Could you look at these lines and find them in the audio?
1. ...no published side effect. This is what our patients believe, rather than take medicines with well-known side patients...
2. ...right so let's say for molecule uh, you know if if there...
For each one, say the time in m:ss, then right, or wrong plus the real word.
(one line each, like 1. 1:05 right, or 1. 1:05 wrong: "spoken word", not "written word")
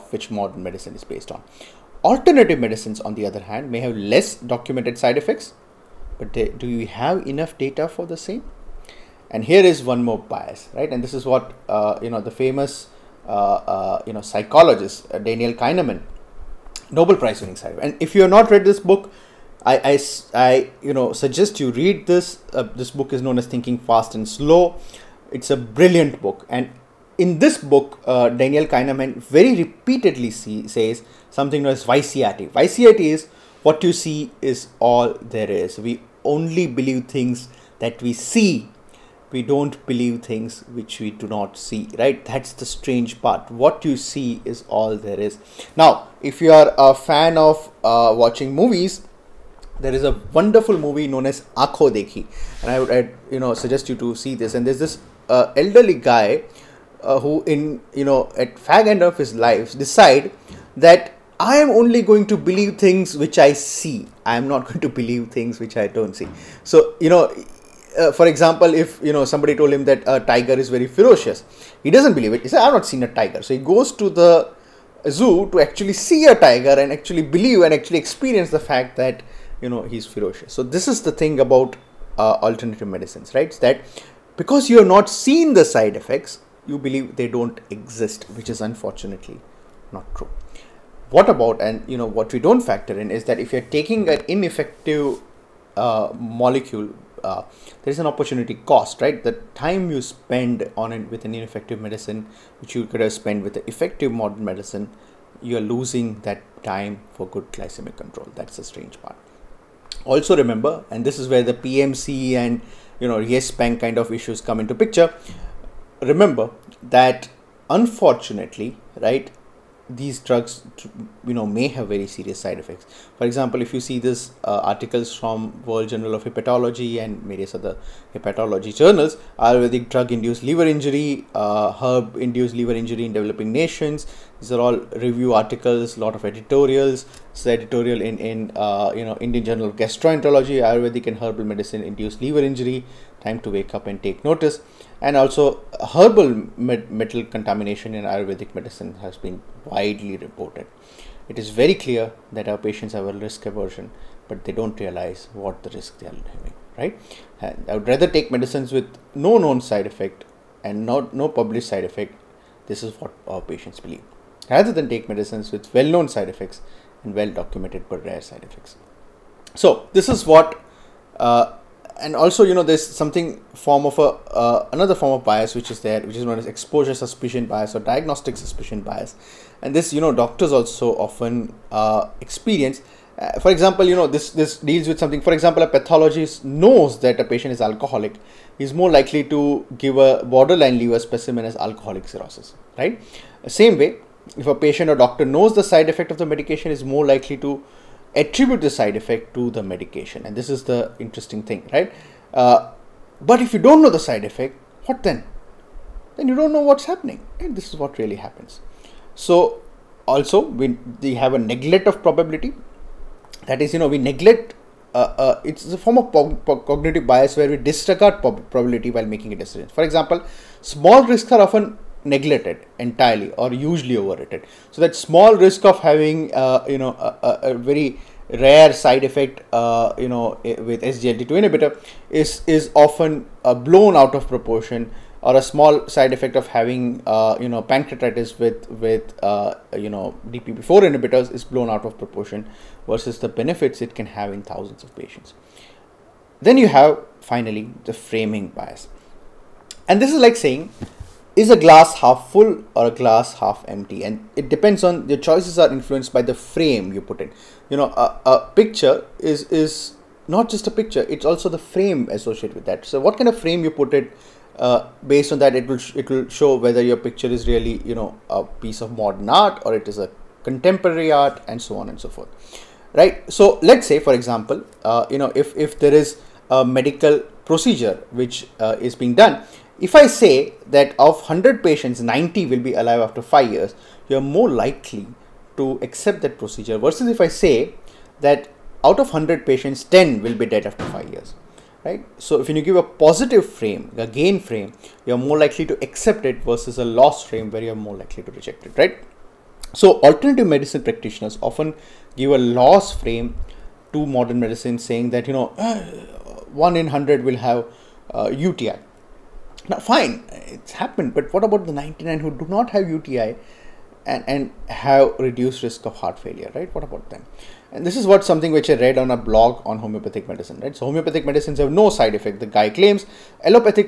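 1. 2:41 wrong: "effects", not "patients"
2. 4:32 wrong: "example", not "molecule".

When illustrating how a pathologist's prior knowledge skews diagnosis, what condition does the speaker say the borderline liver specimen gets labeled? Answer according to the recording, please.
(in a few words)
alcoholic cirrhosis.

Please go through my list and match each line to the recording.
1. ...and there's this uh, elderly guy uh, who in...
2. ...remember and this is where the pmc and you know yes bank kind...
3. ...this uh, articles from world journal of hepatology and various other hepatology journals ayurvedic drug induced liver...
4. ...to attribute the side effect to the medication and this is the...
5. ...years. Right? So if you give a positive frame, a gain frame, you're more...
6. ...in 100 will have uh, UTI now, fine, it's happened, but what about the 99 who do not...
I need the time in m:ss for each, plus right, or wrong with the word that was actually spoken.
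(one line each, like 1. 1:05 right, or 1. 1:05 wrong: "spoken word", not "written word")
1. 0:54 right
2. 1:50 right
3. 2:03 right
4. 3:17 right
5. 4:51 right
6. 5:06 right.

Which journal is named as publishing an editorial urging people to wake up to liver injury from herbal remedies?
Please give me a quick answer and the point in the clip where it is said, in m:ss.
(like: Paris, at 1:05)
Indian Journal of Gastroenterology, at 2:19.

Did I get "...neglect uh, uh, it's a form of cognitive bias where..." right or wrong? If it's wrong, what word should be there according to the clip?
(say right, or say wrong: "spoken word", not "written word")
right.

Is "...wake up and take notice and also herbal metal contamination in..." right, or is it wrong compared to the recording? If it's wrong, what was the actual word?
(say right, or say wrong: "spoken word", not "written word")
right.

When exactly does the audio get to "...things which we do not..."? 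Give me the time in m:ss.
0:40.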